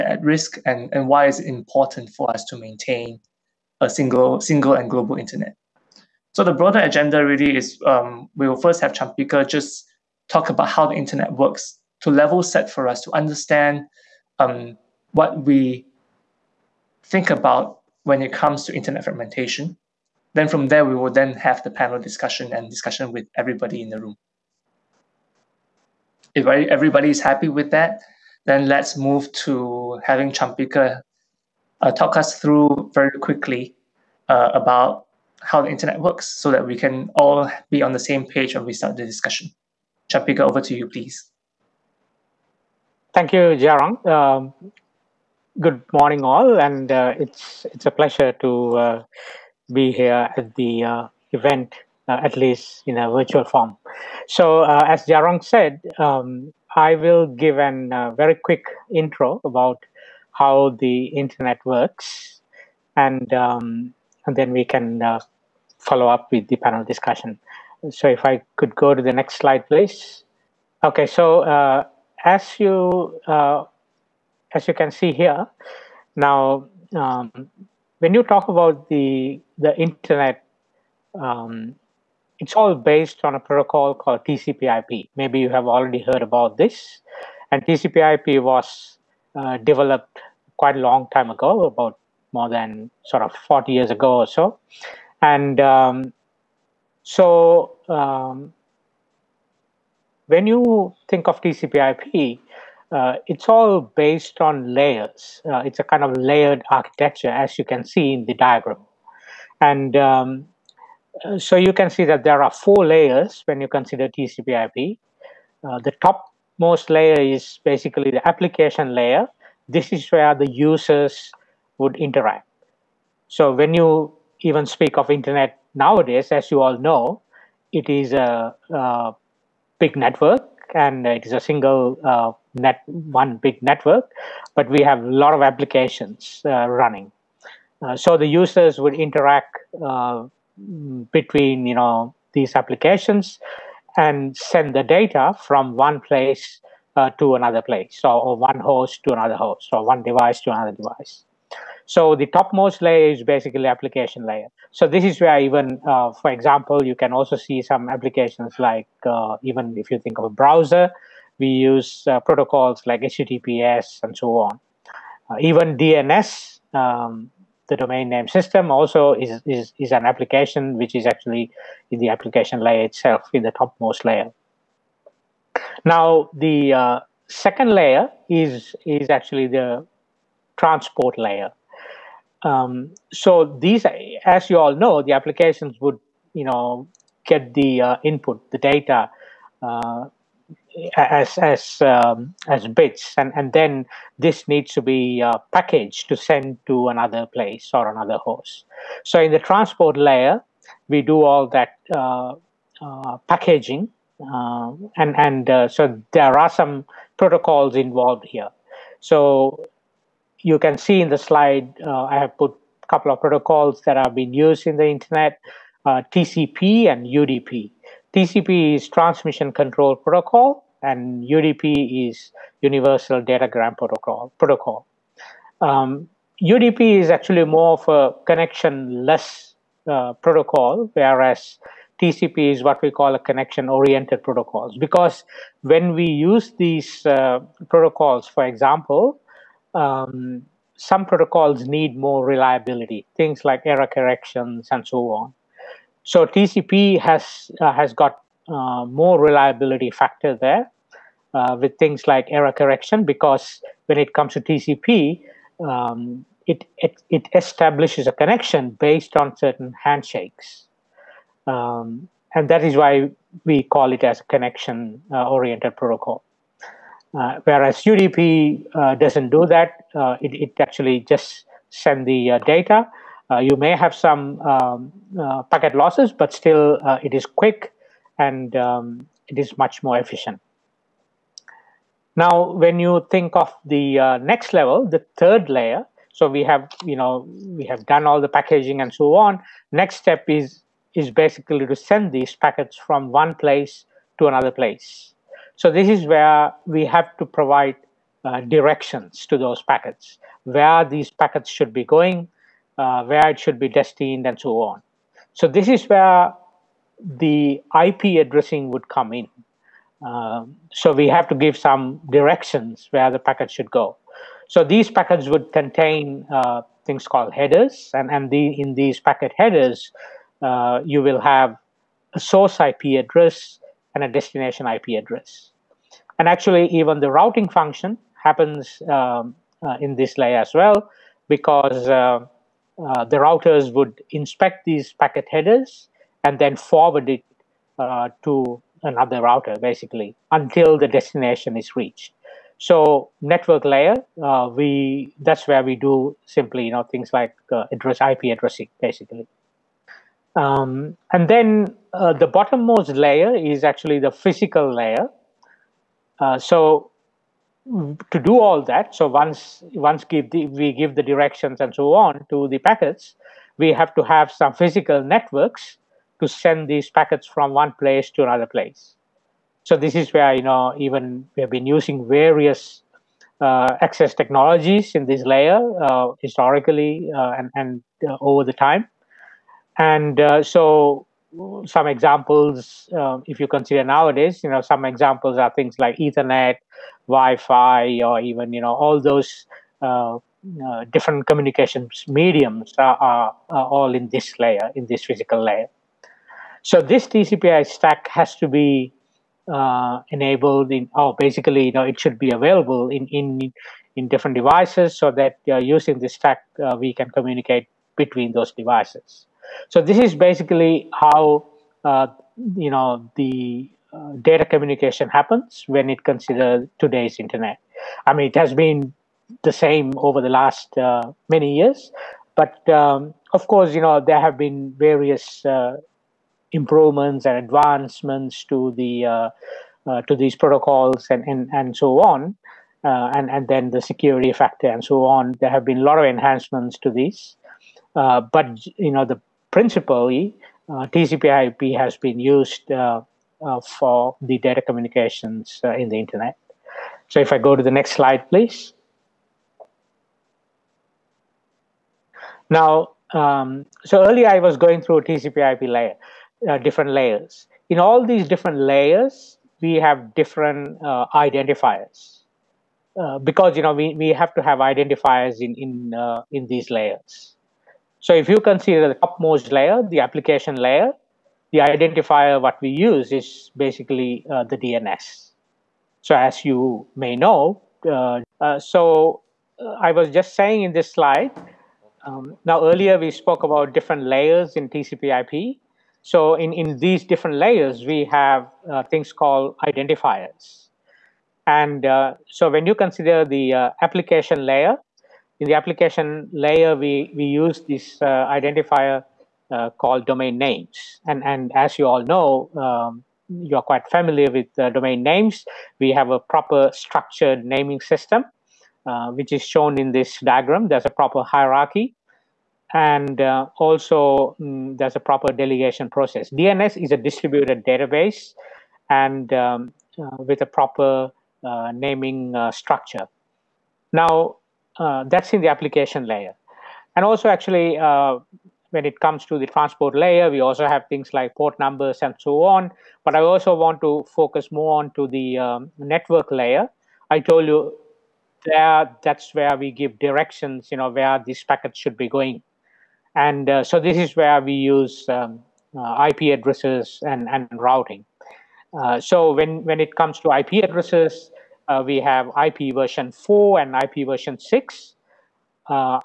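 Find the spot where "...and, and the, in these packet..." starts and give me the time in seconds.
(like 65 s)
317 s.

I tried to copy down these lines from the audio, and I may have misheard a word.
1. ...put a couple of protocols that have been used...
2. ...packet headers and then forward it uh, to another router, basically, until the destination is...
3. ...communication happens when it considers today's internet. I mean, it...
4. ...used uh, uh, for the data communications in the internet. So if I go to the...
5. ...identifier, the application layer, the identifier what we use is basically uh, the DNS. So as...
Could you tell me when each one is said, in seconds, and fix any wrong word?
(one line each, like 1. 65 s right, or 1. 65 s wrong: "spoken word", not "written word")
1. 212 s right
2. 334 s right
3. 414 s right
4. 442 s right
5. 469 s wrong: "layer", not "identifier".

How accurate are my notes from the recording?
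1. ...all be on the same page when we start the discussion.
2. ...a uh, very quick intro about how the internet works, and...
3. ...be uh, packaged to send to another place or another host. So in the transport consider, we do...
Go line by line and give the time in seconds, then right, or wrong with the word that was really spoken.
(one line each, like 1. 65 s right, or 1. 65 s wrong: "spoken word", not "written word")
1. 37 s right
2. 57 s right
3. 194 s wrong: "layer", not "consider".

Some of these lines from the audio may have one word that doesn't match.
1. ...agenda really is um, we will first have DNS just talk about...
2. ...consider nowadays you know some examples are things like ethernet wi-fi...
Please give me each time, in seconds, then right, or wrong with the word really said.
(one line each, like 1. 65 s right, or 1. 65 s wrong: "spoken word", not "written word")
1. 6 s wrong: "Champika", not "DNS"
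2. 383 s right.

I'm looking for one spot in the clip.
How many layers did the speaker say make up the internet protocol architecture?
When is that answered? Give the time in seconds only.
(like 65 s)
112 s.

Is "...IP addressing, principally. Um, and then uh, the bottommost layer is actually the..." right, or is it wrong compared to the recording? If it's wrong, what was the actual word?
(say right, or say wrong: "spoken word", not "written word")
wrong: "basically", not "principally".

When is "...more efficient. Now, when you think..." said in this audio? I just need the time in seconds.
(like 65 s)
279 s.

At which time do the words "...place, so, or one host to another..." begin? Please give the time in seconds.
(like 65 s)
147 s.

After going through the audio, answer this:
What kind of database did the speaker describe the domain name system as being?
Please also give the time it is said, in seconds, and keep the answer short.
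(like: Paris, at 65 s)
distributed database, at 516 s.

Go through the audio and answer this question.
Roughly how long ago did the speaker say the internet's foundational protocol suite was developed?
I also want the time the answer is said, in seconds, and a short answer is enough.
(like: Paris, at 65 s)
more than 40 years, at 92 s.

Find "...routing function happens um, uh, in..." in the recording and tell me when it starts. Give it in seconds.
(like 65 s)
327 s.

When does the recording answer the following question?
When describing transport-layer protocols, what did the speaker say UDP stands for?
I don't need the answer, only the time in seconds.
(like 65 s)
222 s.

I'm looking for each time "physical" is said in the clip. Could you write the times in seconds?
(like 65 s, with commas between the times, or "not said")
354 s, 364 s, 395 s.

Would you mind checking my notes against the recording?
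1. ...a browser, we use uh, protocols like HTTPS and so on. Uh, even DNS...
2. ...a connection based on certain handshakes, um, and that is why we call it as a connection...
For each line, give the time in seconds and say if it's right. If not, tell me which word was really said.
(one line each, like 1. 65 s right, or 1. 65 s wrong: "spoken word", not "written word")
1. 160 s right
2. 258 s right.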